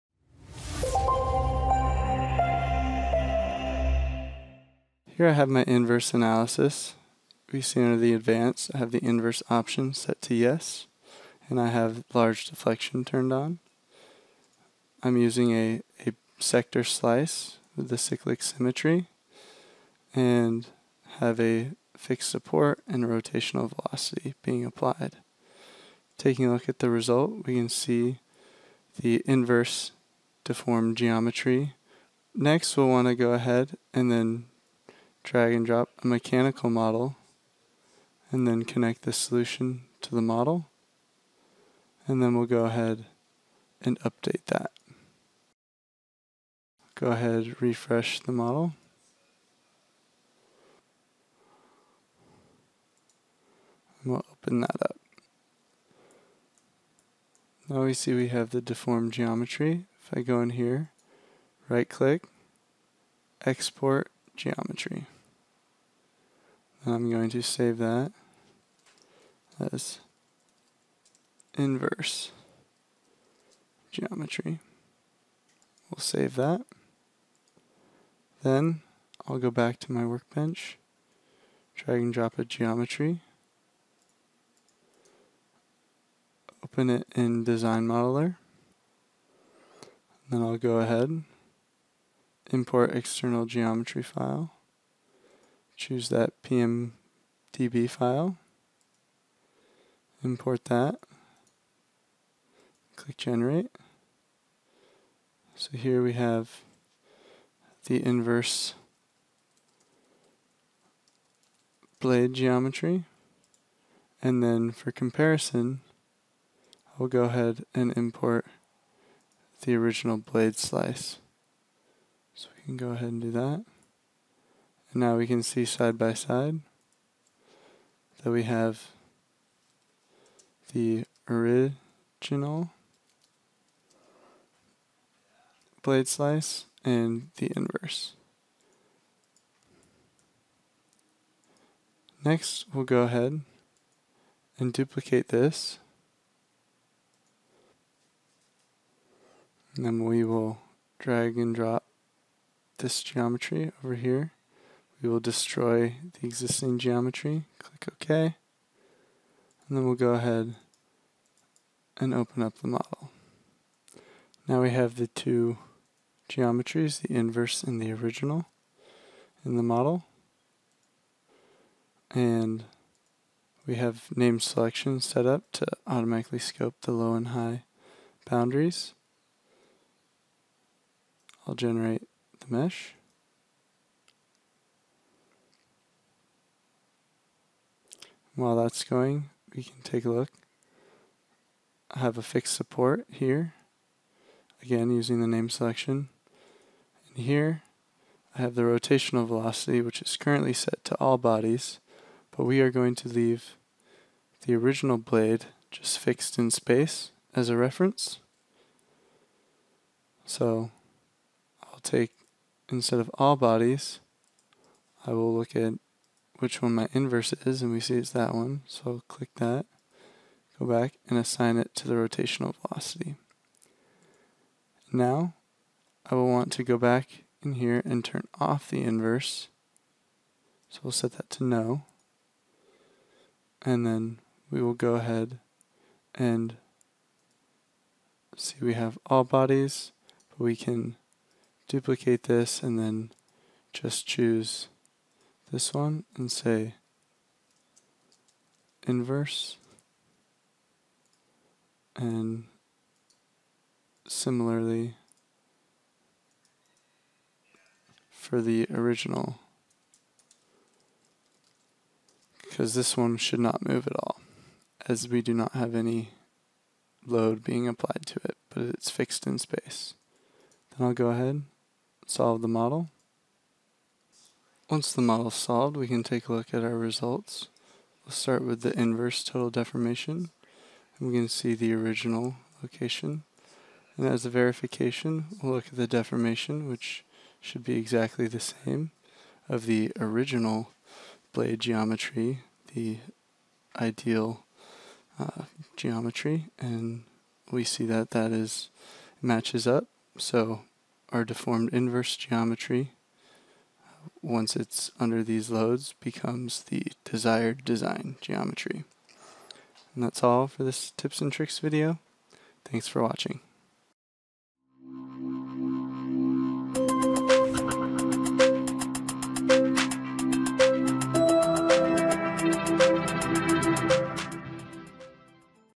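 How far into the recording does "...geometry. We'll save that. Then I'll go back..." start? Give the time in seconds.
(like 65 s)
73 s.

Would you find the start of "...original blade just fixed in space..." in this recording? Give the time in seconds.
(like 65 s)
204 s.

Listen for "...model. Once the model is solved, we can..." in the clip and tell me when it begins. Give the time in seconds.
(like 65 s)
272 s.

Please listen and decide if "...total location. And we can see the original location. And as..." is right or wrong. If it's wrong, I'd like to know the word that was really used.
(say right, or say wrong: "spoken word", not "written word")
wrong: "deformation", not "location".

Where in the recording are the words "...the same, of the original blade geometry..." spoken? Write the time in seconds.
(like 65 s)
288 s.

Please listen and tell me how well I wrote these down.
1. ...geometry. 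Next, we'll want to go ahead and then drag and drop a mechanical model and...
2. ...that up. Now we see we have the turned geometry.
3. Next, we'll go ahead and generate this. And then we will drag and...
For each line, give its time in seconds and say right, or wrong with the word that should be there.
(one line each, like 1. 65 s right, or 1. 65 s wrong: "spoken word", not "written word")
1. 30 s right
2. 54 s wrong: "deformed", not "turned"
3. 142 s wrong: "duplicate", not "generate".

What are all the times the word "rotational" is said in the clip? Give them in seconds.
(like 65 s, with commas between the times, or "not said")
23 s, 198 s, 221 s.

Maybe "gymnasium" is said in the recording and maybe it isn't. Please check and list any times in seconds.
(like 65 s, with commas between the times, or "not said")
not said.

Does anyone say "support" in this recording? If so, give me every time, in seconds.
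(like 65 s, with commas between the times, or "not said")
22 s, 192 s.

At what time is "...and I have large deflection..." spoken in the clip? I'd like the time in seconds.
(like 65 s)
11 s.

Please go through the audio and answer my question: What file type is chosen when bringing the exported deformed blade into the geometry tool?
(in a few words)
PMDB.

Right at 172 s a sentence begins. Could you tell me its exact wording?
And we have name selection set up to automatically scope the low and high boundaries.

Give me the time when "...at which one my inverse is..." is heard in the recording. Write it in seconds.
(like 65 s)
215 s.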